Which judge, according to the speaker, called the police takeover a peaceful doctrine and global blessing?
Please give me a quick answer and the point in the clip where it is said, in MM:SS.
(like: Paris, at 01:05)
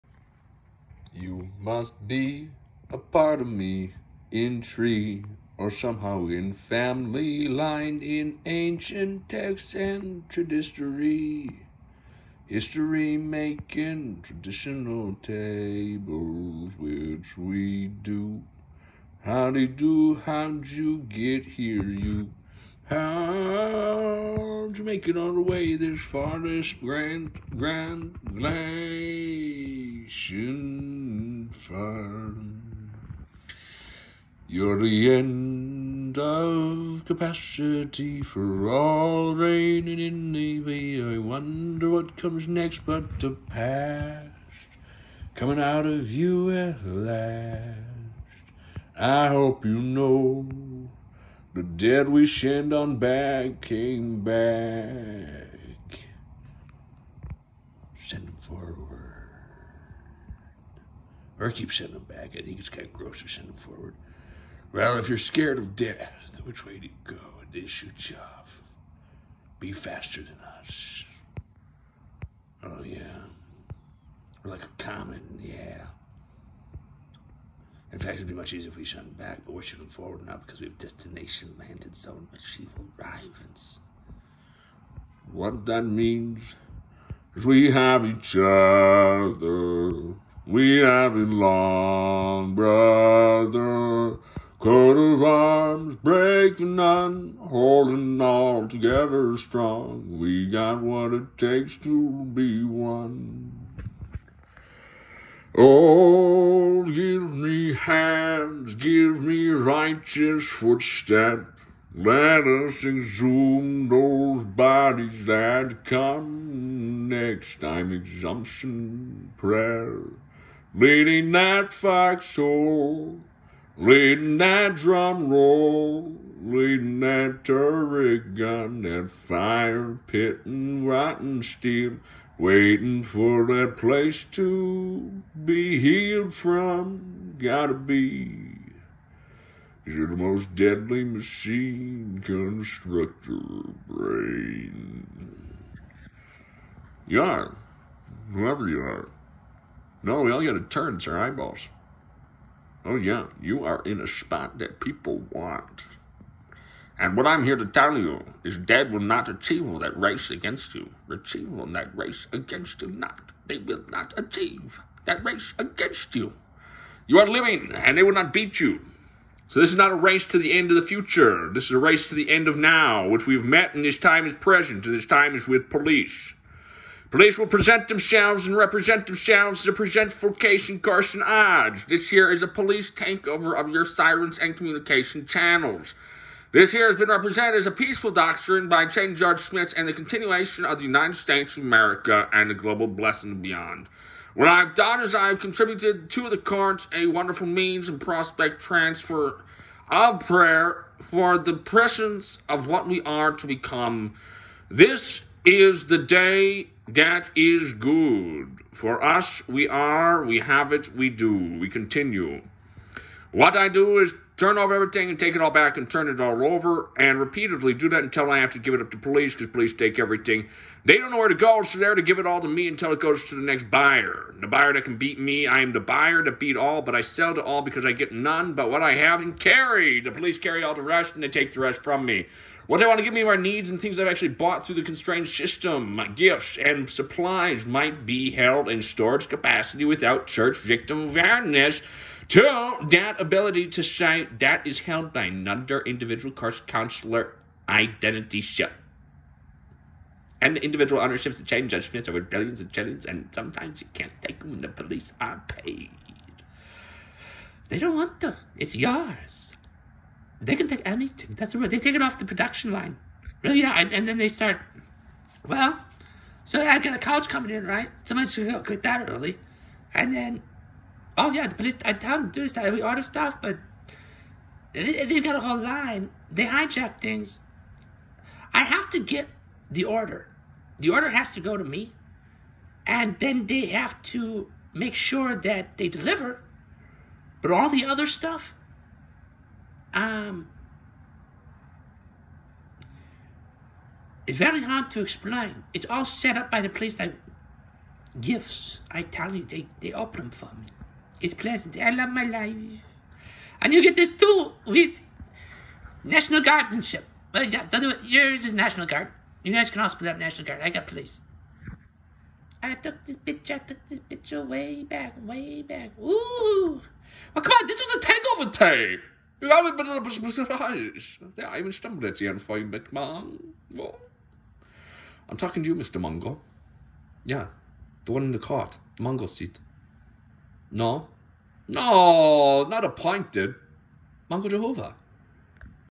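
Chain Judge Smith, at 03:08.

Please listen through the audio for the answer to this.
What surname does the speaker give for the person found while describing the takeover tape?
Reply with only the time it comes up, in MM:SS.
05:22.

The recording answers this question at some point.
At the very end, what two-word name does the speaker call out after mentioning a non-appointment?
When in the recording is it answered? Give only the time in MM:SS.
05:34.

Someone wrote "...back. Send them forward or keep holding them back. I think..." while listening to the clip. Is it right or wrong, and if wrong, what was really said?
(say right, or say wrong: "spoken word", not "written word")
wrong: "sending", not "holding".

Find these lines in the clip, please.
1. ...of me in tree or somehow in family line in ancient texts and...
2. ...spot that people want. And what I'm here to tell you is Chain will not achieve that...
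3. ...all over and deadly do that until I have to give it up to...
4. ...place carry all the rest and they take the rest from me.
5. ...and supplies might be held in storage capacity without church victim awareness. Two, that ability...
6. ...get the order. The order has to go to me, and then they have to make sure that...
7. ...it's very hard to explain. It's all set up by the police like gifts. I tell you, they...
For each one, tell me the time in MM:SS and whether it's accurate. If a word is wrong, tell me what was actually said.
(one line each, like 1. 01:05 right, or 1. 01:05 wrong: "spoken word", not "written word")
1. 00:03 right
2. 02:34 wrong: "Dad", not "Chain"
3. 03:36 wrong: "repeatedly", not "deadly"
4. 03:50 wrong: "police", not "place"
5. 03:56 right
6. 04:38 right
7. 04:54 right.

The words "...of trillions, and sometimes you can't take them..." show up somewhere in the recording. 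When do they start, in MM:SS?
04:12.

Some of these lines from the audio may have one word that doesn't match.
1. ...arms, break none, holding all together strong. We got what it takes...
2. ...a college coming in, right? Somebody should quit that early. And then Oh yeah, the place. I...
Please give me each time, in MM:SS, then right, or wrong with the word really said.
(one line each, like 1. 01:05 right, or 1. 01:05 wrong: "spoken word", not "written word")
1. 01:35 right
2. 04:26 wrong: "police", not "place".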